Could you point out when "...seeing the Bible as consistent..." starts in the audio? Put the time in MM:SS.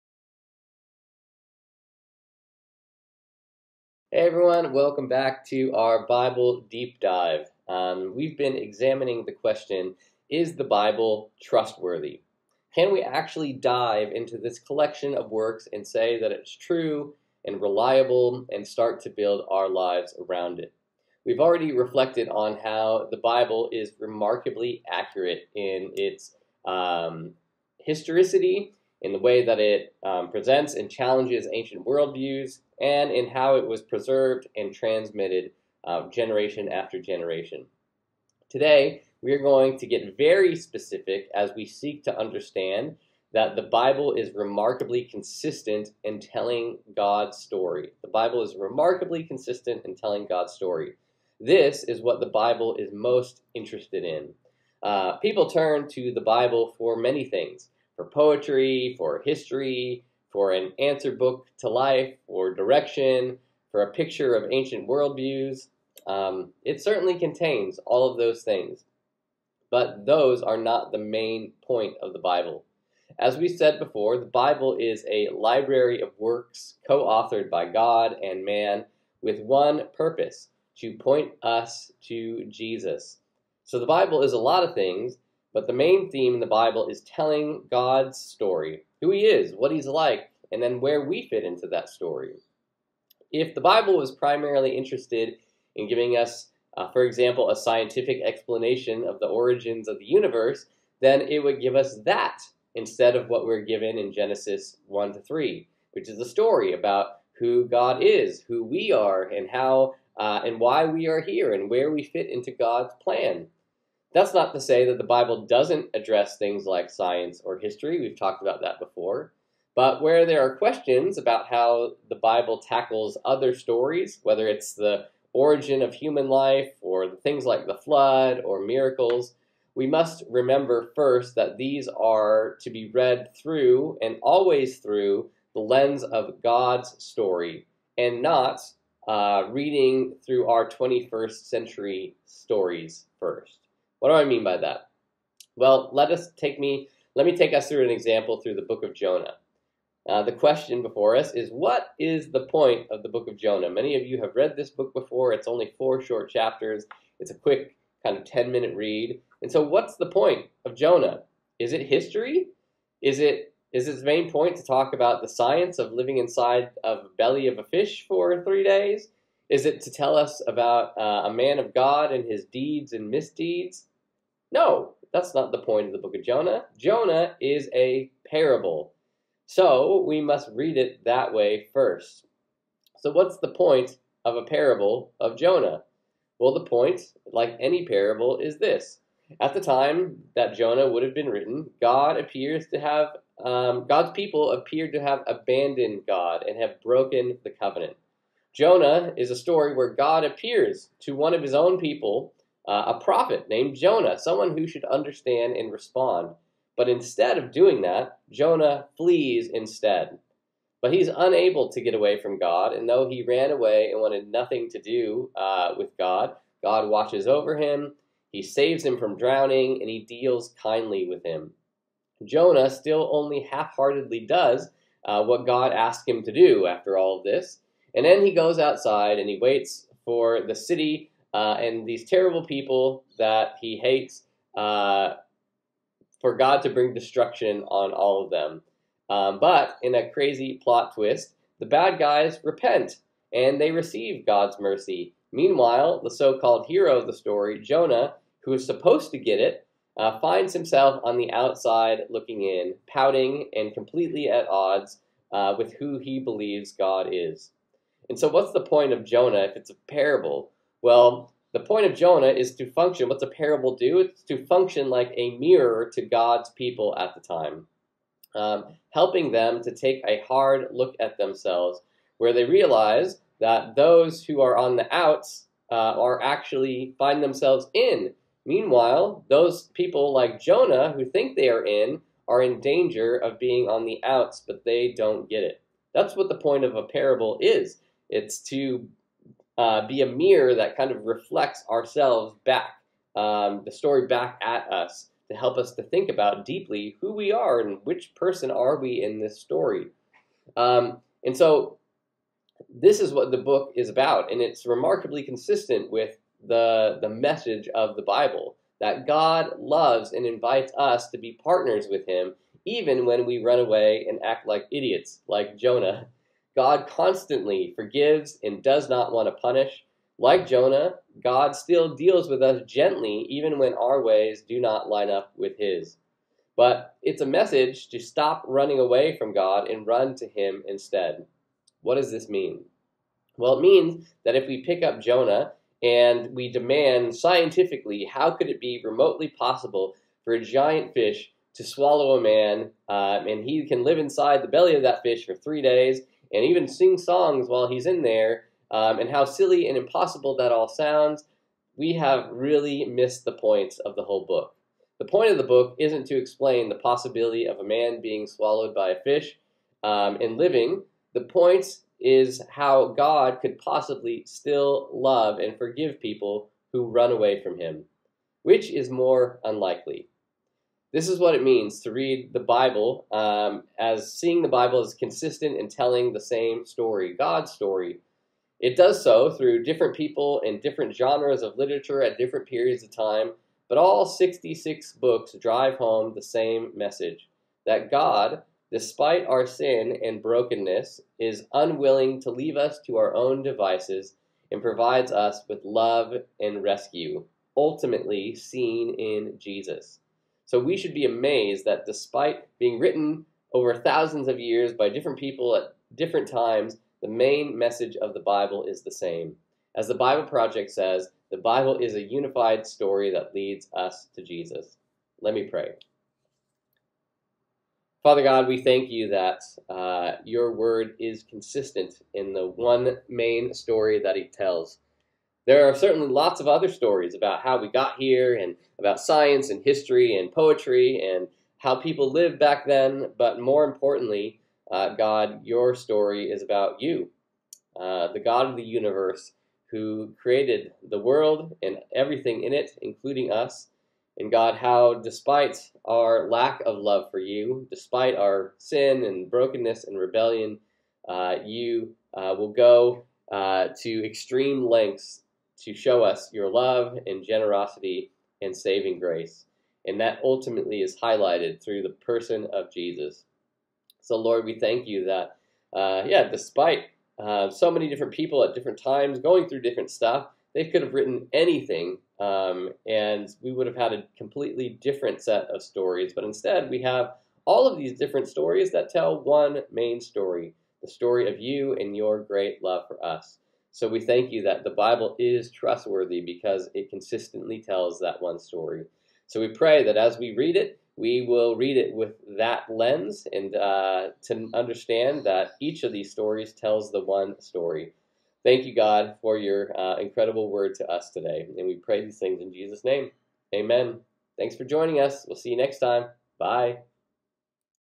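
06:14.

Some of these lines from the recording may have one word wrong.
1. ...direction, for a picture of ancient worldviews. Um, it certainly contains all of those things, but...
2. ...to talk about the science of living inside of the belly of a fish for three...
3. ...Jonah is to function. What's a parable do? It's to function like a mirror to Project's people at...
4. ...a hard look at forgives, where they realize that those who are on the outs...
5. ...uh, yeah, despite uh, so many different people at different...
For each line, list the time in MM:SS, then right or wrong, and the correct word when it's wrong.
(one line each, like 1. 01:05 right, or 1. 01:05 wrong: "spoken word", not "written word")
1. 01:02 right
2. 02:44 right
3. 04:21 wrong: "God", not "Project"
4. 04:30 wrong: "themselves", not "forgives"
5. 07:45 right.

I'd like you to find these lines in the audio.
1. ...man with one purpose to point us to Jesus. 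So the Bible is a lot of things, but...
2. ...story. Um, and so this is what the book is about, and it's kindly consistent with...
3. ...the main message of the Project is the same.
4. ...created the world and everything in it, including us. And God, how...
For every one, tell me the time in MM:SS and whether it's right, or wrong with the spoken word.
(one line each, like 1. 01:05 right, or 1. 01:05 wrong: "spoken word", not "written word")
1. 01:18 right
2. 04:59 wrong: "remarkably", not "kindly"
3. 06:47 wrong: "Bible", not "Project"
4. 07:20 right.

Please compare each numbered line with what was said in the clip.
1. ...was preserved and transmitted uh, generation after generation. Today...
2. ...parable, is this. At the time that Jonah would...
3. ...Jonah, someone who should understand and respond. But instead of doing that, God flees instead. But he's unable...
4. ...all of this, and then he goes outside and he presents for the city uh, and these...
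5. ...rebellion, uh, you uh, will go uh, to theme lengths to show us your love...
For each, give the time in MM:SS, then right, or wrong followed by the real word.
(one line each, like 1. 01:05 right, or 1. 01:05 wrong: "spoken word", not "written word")
1. 00:33 right
2. 03:07 right
3. 03:23 wrong: "Jonah", not "God"
4. 03:46 wrong: "waits", not "presents"
5. 07:29 wrong: "extreme", not "theme".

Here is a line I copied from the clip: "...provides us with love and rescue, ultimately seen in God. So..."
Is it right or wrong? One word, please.
wrong.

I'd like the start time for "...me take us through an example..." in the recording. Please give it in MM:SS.
02:27.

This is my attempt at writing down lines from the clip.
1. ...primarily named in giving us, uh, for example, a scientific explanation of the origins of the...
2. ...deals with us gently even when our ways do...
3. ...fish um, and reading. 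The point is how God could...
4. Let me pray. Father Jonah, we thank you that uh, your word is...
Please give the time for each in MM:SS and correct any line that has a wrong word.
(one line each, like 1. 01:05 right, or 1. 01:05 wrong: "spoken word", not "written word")
1. 01:34 wrong: "interested", not "named"
2. 05:21 right
3. 05:59 wrong: "living", not "reading"
4. 06:55 wrong: "God", not "Jonah".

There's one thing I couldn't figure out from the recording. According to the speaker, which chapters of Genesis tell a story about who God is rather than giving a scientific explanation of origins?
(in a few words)
1 to 3.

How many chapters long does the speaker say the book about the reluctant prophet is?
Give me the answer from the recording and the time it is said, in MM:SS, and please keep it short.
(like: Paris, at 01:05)
4, at 02:35.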